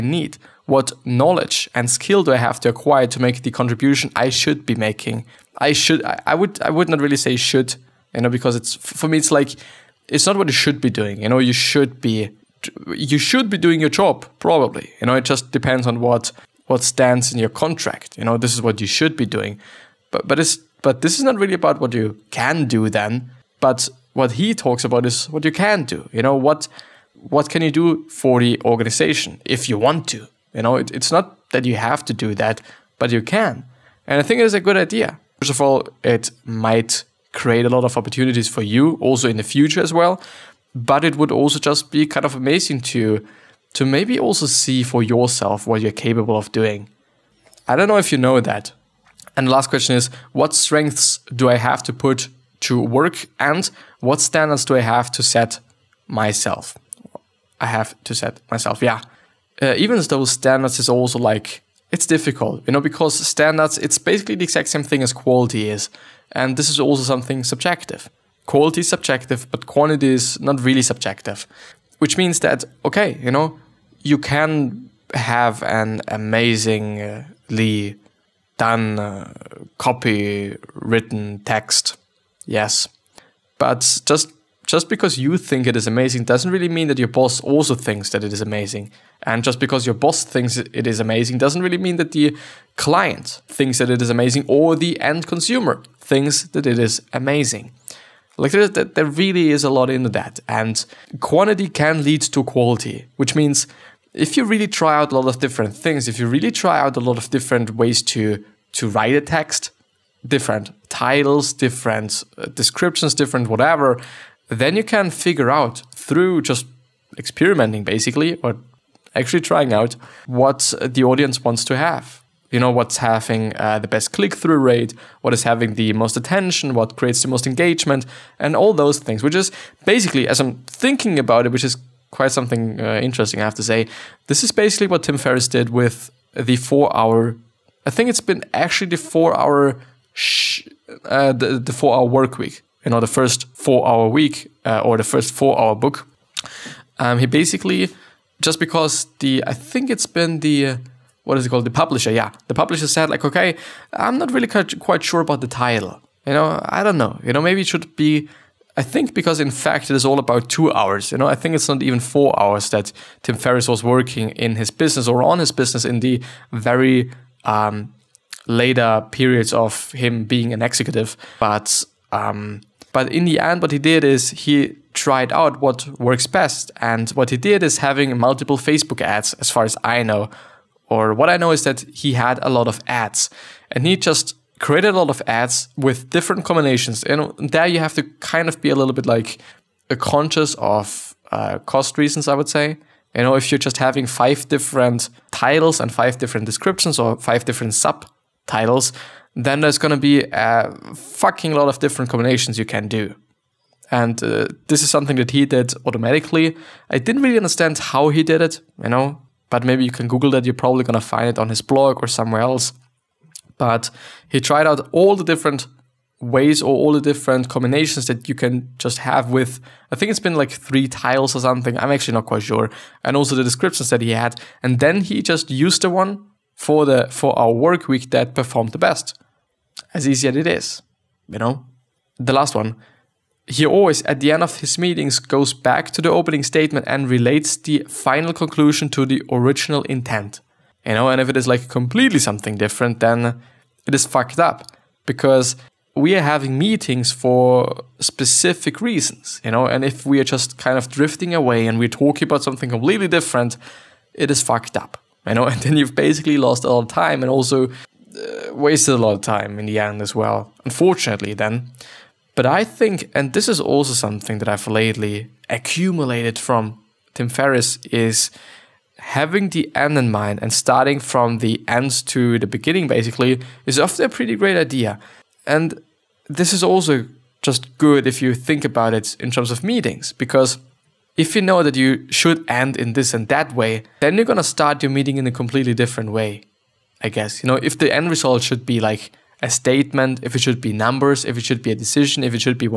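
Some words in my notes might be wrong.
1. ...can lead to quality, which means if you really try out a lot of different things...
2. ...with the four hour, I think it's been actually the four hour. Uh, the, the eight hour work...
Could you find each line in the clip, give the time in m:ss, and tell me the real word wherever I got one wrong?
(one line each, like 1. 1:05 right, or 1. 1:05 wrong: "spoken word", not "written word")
1. 1:41 right
2. 2:15 wrong: "four", not "eight".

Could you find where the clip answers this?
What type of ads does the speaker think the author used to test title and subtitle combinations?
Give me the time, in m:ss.
2:58.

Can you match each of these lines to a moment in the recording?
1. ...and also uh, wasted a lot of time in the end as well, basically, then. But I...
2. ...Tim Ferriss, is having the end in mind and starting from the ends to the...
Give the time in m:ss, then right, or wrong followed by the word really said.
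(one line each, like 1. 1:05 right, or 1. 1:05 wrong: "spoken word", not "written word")
1. 4:17 wrong: "unfortunately", not "basically"
2. 4:27 right.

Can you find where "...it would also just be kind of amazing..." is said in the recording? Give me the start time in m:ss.
0:41.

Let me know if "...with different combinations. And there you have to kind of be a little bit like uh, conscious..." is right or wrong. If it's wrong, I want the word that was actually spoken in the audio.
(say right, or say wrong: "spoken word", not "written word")
right.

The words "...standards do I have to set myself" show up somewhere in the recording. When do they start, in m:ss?
0:54.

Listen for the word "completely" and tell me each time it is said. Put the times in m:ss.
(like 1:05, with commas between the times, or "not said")
4:01, 4:12, 4:45.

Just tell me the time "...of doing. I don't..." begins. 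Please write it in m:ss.
0:46.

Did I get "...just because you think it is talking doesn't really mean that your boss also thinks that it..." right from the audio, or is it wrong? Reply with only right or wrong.
wrong.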